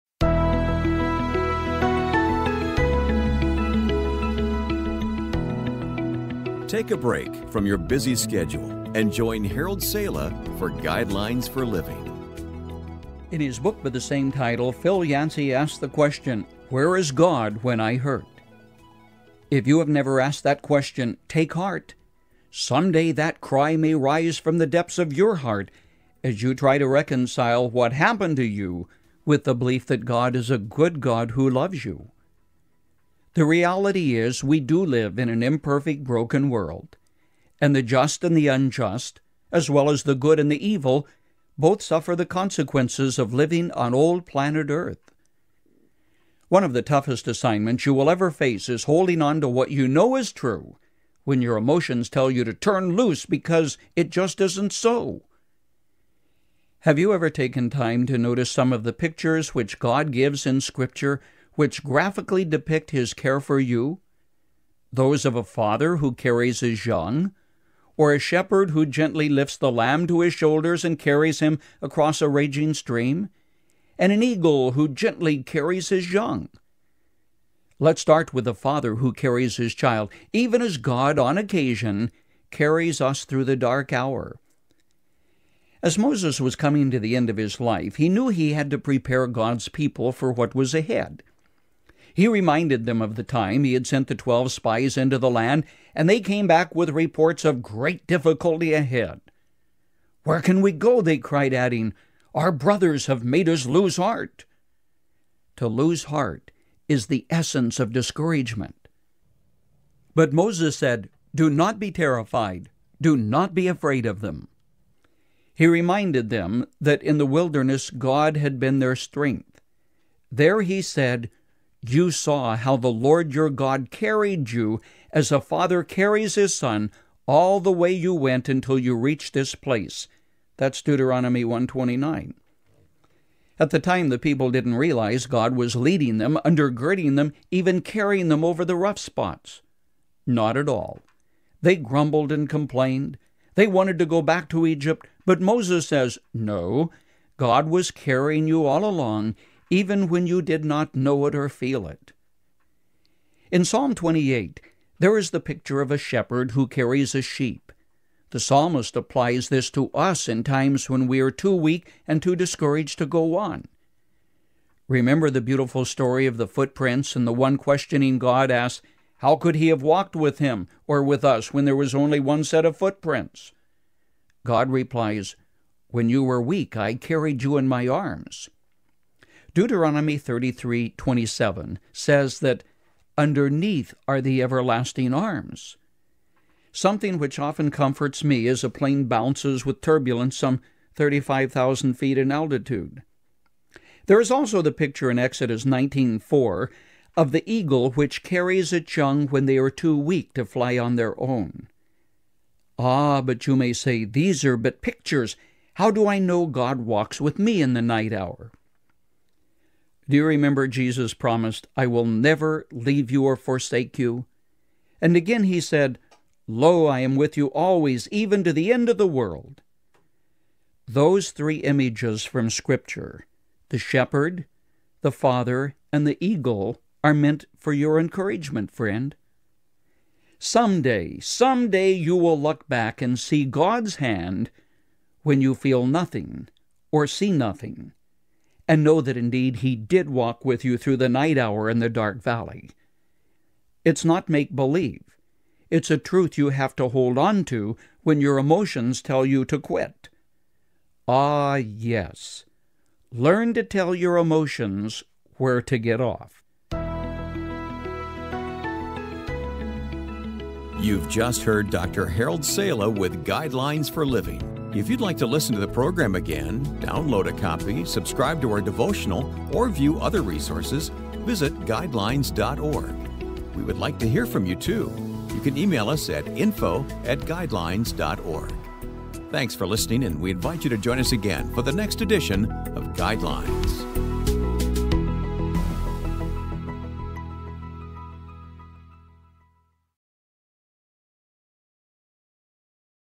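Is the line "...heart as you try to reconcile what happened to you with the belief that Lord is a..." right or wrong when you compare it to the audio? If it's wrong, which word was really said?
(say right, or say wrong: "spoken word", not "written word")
wrong: "God", not "Lord".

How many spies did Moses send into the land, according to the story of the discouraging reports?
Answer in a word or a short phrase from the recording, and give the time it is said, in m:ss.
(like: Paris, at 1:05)
12, at 1:34.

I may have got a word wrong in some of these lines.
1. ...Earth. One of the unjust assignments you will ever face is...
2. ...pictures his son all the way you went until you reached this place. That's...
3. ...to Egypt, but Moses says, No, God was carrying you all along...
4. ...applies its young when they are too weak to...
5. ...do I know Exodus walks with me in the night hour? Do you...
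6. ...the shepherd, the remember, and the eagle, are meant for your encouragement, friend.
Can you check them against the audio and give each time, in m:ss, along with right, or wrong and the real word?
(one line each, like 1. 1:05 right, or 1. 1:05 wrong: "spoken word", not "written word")
1. 0:44 wrong: "toughest", not "unjust"
2. 2:05 wrong: "carries", not "pictures"
3. 2:24 right
4. 3:18 wrong: "carries", not "applies"
5. 3:25 wrong: "God", not "Exodus"
6. 3:43 wrong: "father", not "remember".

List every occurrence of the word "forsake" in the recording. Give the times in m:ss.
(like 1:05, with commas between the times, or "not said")
3:33.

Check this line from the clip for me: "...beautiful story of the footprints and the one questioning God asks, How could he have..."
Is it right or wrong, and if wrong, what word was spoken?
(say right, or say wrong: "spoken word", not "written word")
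right.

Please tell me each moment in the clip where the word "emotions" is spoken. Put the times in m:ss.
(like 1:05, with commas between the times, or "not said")
0:51, 4:08, 4:14.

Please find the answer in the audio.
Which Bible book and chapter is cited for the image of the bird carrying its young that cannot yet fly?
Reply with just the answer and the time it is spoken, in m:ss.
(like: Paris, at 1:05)
Exodus 19:4, at 3:15.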